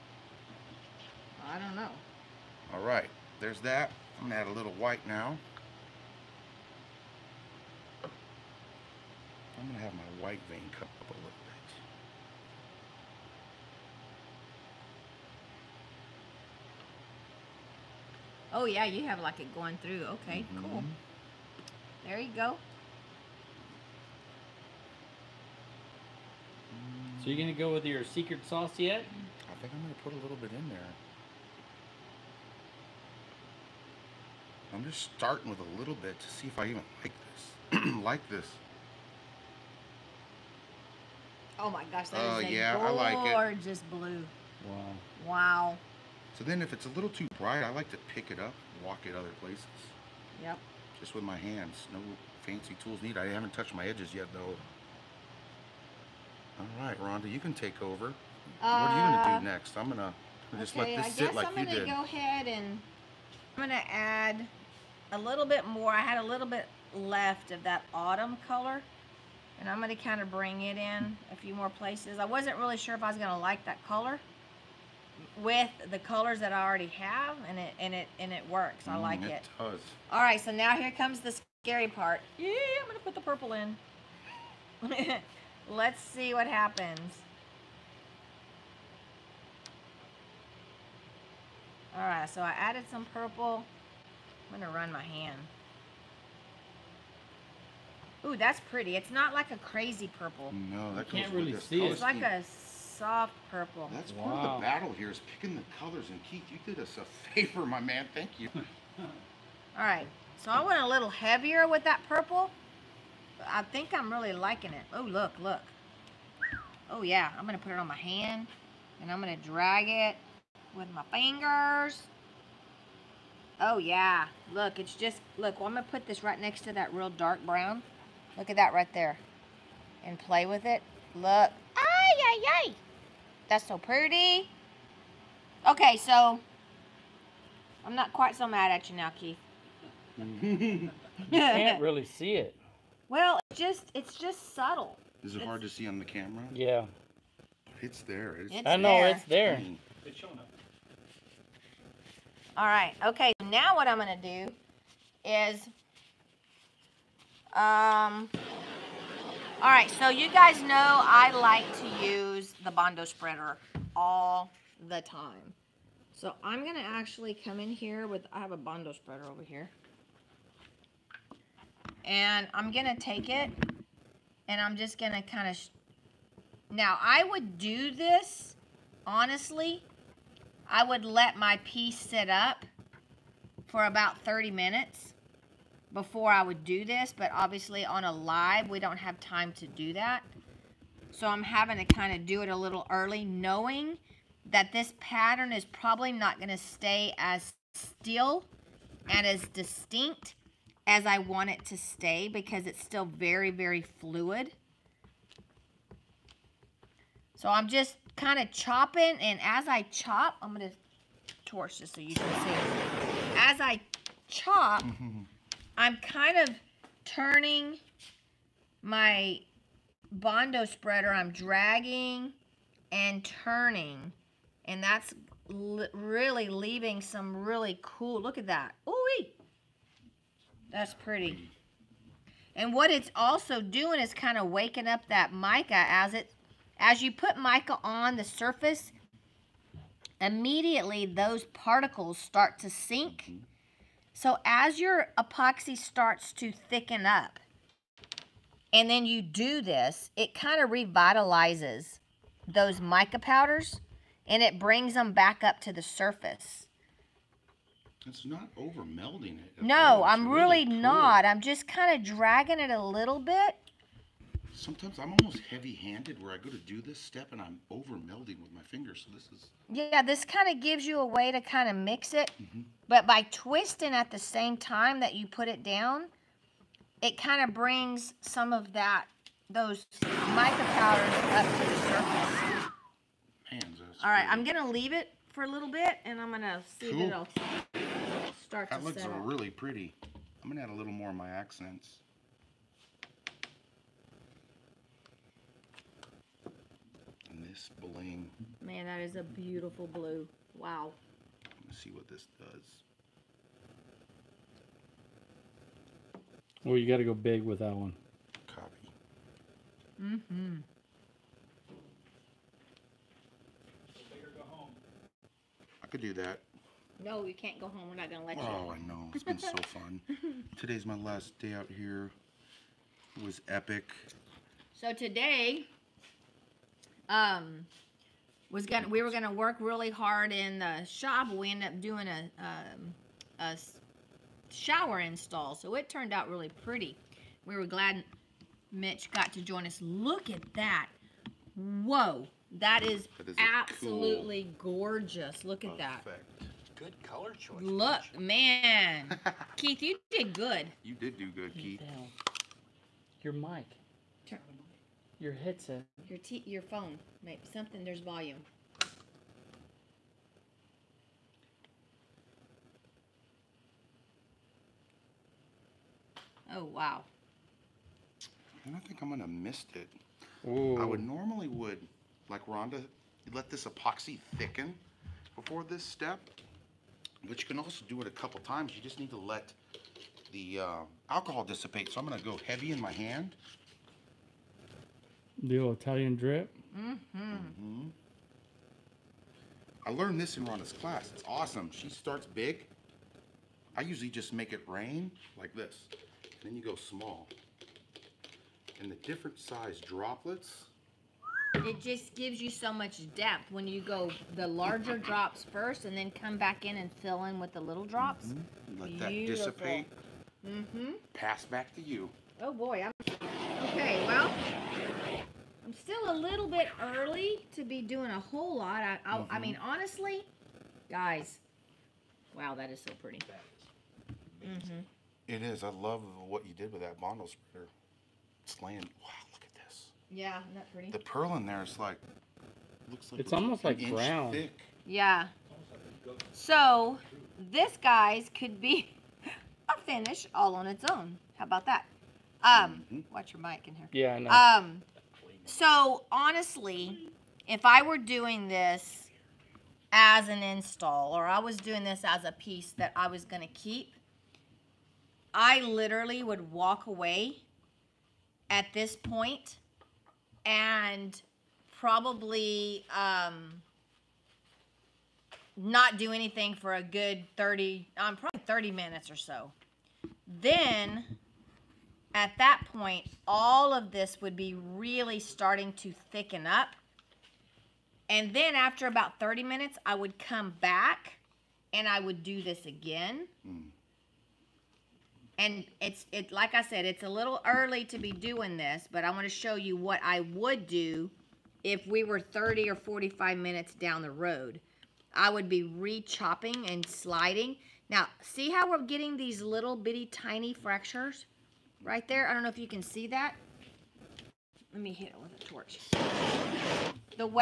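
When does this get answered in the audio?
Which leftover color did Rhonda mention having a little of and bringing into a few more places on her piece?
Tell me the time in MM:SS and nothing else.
01:07.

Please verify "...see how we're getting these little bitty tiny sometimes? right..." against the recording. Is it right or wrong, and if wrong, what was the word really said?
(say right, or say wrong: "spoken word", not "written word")
wrong: "fractures", not "sometimes".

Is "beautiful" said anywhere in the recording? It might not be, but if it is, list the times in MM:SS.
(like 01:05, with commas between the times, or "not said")
04:59, 06:48.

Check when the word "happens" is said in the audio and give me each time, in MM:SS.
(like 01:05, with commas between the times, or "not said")
01:26.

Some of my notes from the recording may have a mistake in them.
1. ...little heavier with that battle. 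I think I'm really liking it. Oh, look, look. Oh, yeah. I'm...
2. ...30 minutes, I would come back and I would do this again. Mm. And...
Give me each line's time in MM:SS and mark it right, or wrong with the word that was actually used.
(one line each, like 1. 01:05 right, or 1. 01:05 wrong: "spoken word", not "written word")
1. 01:50 wrong: "purple", not "battle"
2. 07:59 right.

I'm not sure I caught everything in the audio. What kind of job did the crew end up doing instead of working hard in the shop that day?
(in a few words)
A shower install.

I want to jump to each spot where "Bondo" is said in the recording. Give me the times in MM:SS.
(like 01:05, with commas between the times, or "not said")
02:42, 02:48, 03:40, 07:06.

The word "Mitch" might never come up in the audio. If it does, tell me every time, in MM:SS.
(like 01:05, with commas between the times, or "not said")
05:38, 05:48.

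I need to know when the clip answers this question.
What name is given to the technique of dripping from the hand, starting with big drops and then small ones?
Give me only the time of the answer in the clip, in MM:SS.
06:25.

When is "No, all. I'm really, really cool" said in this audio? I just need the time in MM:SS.
04:19.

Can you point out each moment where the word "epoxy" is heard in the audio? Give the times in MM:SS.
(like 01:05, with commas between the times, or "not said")
04:05, 06:13.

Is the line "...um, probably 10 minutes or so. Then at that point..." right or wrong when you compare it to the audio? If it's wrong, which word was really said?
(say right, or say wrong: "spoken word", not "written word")
wrong: "30", not "10".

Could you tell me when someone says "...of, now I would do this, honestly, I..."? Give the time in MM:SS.
02:55.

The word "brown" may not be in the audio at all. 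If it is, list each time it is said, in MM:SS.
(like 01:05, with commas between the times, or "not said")
02:07, 07:13.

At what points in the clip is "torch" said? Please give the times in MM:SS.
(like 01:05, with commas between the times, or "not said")
03:31, 08:25.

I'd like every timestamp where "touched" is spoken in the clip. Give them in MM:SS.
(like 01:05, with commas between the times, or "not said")
00:53.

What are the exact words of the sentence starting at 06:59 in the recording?
honestly, guys, wow, that is so pretty.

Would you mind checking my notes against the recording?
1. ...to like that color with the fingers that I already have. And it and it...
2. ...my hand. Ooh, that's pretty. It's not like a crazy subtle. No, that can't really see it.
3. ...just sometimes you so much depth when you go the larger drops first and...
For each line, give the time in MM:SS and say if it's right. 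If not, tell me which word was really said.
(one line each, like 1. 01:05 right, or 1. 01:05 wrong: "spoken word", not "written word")
1. 01:13 wrong: "colors", not "fingers"
2. 01:34 wrong: "purple", not "subtle"
3. 06:41 wrong: "gives", not "sometimes".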